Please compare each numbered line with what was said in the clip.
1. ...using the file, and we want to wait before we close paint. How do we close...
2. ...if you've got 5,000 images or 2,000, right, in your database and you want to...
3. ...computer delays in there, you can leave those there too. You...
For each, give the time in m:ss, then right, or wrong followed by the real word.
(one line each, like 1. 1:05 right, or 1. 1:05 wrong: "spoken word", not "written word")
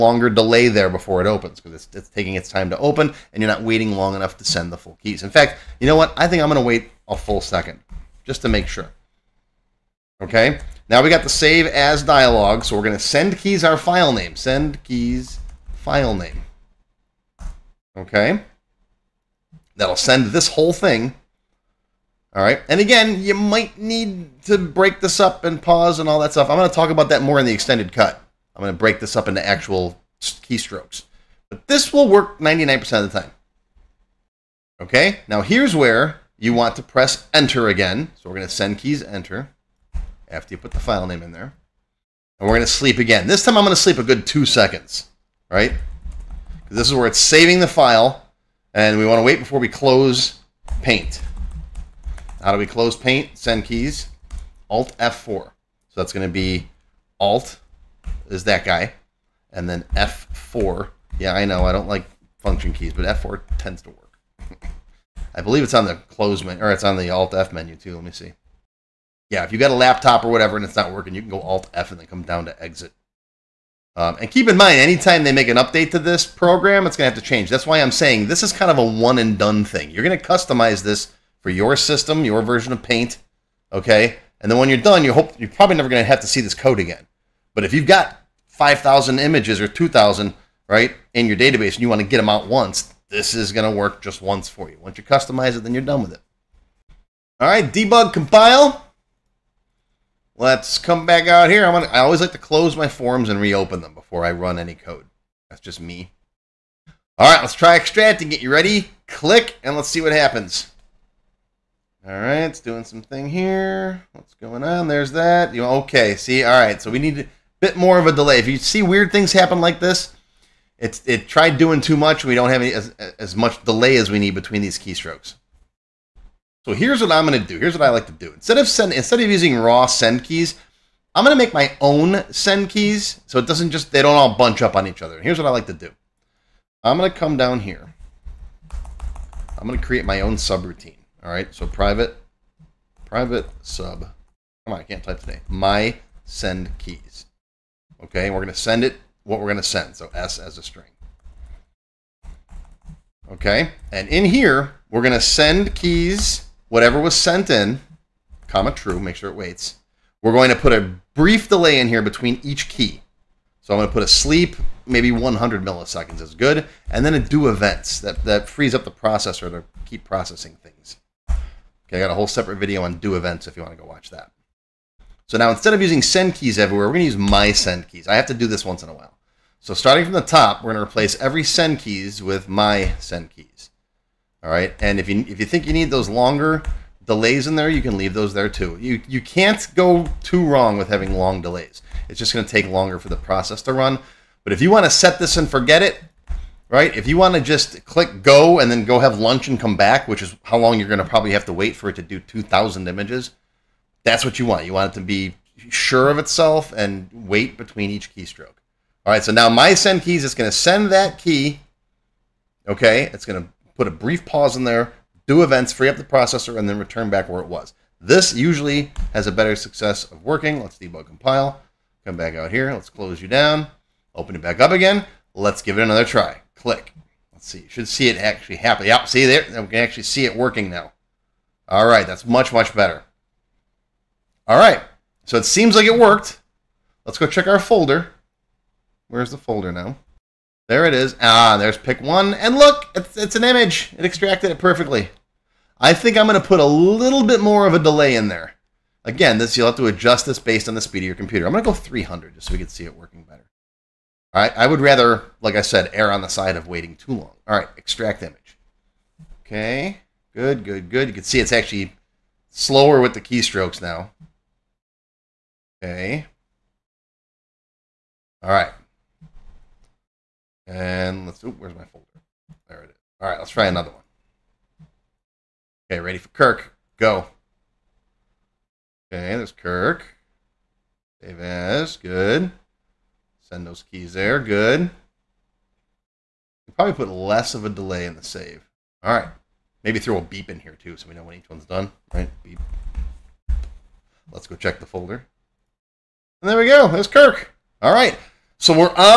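1. 0:47 wrong: "saving", not "using"
2. 1:27 right
3. 3:06 wrong: "longer", not "computer".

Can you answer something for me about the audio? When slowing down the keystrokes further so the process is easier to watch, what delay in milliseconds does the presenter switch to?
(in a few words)
300.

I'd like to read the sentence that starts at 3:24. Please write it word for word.
You want it to be sure of itself and wait between each keystroke.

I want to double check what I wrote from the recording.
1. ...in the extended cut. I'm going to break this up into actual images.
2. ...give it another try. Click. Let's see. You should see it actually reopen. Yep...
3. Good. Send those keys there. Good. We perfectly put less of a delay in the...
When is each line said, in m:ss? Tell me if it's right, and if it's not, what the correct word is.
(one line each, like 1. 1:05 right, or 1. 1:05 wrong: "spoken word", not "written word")
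1. 0:27 wrong: "keystrokes", not "images"
2. 3:45 wrong: "happen", not "reopen"
3. 4:41 wrong: "probably", not "perfectly".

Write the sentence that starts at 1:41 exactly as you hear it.
I I always like to close my forms and reopen them before I run any code.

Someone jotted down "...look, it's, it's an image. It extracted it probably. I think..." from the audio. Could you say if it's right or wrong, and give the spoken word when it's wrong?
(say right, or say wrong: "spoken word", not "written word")
wrong: "perfectly", not "probably".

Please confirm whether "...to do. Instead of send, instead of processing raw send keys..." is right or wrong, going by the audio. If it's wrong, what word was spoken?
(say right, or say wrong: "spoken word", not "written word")
wrong: "using", not "processing".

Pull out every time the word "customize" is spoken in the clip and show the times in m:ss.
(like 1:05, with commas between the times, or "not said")
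1:20, 1:35.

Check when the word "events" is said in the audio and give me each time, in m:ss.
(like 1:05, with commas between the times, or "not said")
2:47, 2:53, 3:35.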